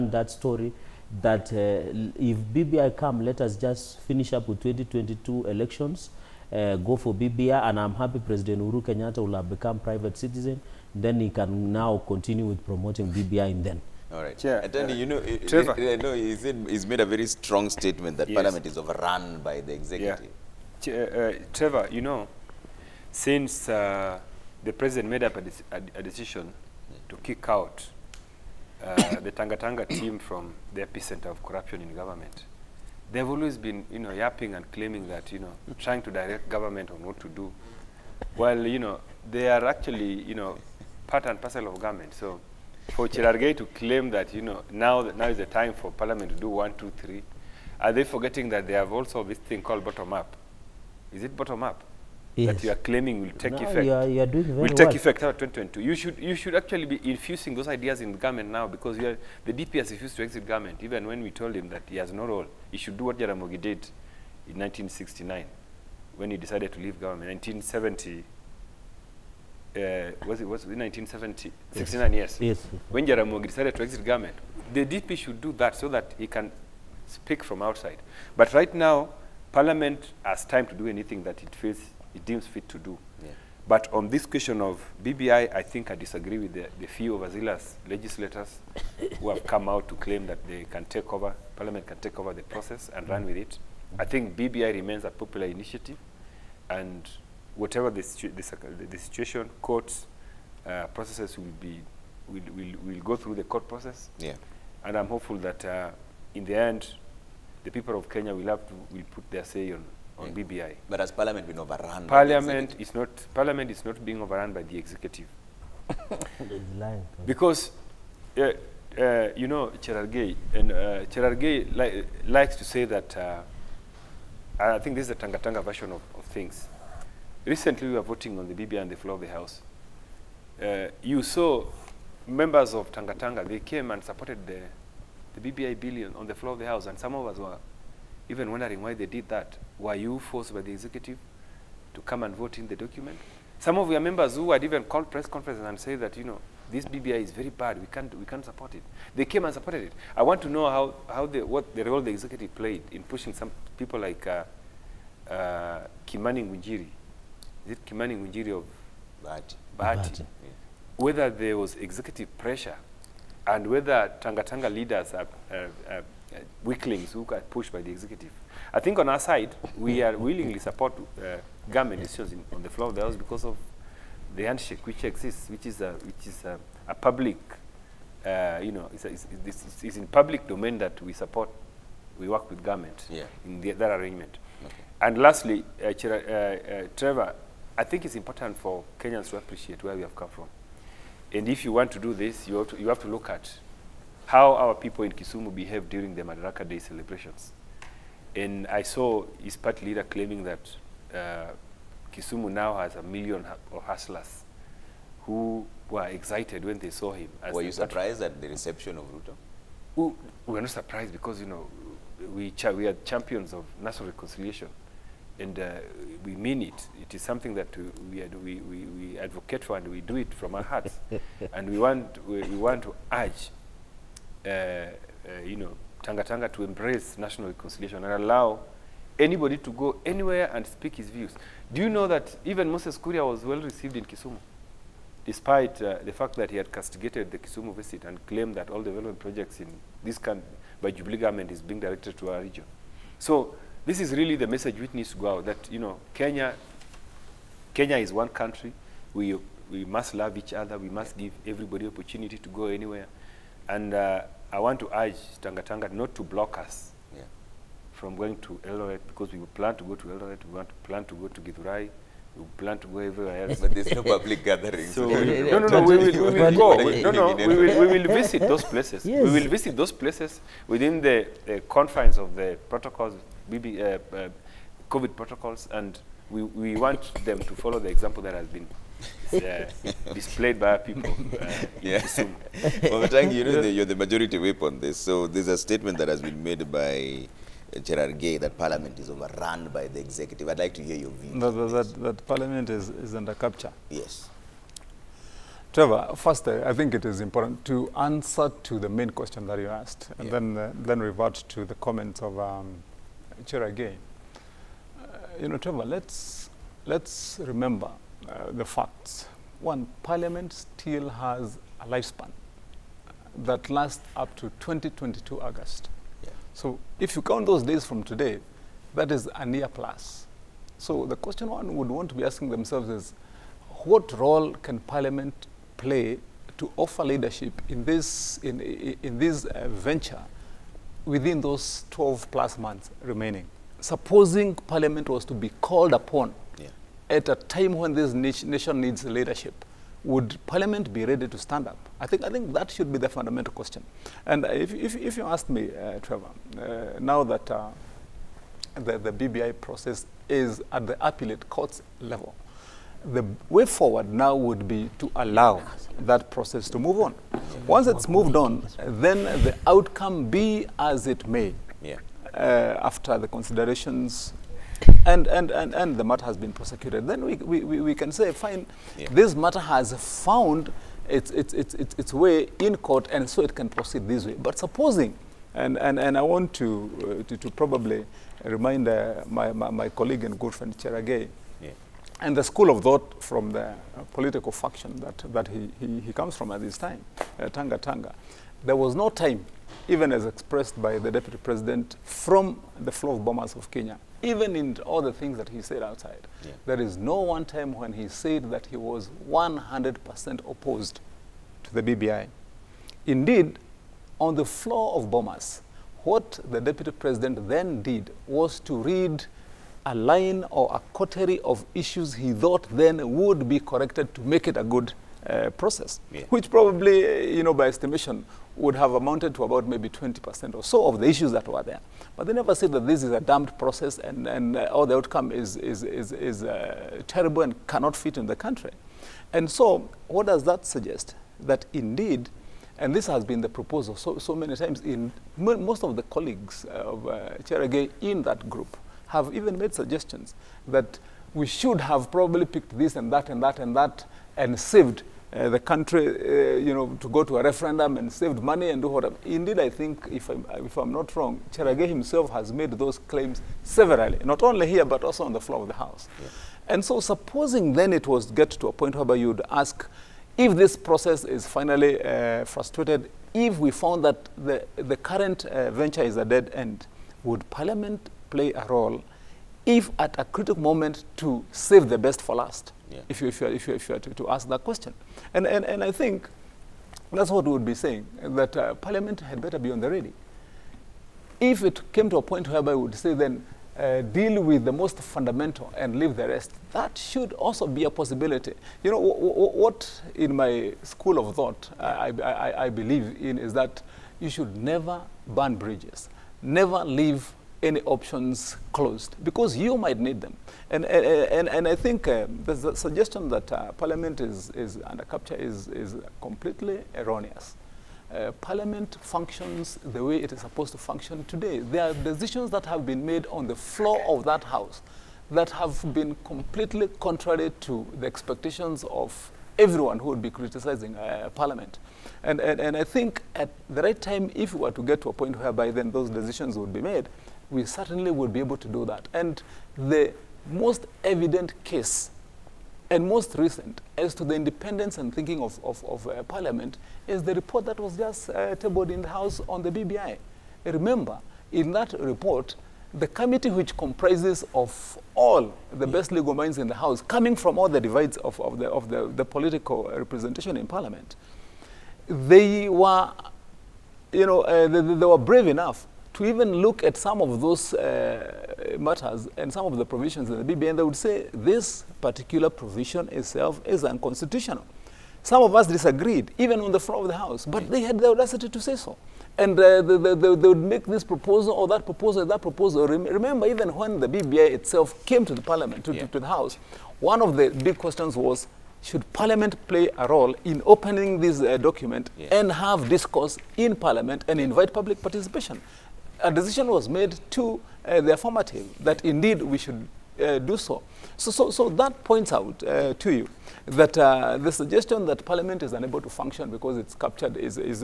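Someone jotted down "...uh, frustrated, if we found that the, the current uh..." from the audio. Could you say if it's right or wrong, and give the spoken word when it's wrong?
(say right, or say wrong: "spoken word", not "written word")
right.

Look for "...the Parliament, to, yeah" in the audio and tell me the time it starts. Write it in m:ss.
9:35.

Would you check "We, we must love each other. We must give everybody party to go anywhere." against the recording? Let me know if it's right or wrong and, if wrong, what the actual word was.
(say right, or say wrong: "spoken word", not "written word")
wrong: "opportunity", not "party".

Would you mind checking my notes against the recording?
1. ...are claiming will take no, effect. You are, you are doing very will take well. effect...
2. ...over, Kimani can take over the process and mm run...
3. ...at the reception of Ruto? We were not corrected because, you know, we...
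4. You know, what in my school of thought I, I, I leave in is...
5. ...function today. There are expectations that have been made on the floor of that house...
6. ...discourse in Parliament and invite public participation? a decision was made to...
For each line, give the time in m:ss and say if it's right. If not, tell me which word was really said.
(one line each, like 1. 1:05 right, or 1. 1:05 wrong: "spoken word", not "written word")
1. 0:52 right
2. 1:31 wrong: "Parliament", not "Kimani"
3. 3:28 wrong: "surprised", not "corrected"
4. 8:08 wrong: "believe", not "leave"
5. 8:30 wrong: "decisions", not "expectations"
6. 9:42 right.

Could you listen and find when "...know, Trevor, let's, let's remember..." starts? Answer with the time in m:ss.
5:05.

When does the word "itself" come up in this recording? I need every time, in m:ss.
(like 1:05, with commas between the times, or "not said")
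9:23, 9:34.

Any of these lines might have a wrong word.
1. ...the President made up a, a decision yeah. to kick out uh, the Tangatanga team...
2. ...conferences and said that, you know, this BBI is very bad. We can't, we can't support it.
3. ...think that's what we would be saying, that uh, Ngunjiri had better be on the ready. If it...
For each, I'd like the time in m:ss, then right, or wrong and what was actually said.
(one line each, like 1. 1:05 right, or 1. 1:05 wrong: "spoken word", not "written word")
1. 0:24 right
2. 2:25 right
3. 7:55 wrong: "Parliament", not "Ngunjiri".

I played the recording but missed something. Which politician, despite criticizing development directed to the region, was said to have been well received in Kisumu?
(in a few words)
Moses Kuria.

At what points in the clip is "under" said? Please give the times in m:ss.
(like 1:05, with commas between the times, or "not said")
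4:53, 8:24.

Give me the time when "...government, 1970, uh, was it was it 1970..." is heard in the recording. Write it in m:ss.
1:07.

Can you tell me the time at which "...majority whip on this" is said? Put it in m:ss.
4:44.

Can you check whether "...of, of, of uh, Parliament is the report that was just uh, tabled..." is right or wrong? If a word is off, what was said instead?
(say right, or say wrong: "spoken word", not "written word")
right.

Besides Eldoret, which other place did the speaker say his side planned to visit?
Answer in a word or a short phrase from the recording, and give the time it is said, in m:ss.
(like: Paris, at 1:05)
Githurai, at 4:21.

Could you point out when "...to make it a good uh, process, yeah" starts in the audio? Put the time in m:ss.
6:54.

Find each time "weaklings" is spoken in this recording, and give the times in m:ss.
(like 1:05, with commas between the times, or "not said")
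2:46.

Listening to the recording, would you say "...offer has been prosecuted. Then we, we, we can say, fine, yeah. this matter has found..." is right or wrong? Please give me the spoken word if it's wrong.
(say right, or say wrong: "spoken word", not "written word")
wrong: "matter", not "offer".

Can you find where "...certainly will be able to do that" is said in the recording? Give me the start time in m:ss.
8:47.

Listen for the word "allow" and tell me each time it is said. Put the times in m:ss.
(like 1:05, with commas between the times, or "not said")
3:48, 5:55.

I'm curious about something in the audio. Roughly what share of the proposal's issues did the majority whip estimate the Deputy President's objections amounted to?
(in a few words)
20%.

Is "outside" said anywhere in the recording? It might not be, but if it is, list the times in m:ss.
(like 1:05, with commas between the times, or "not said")
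1:17, 6:35.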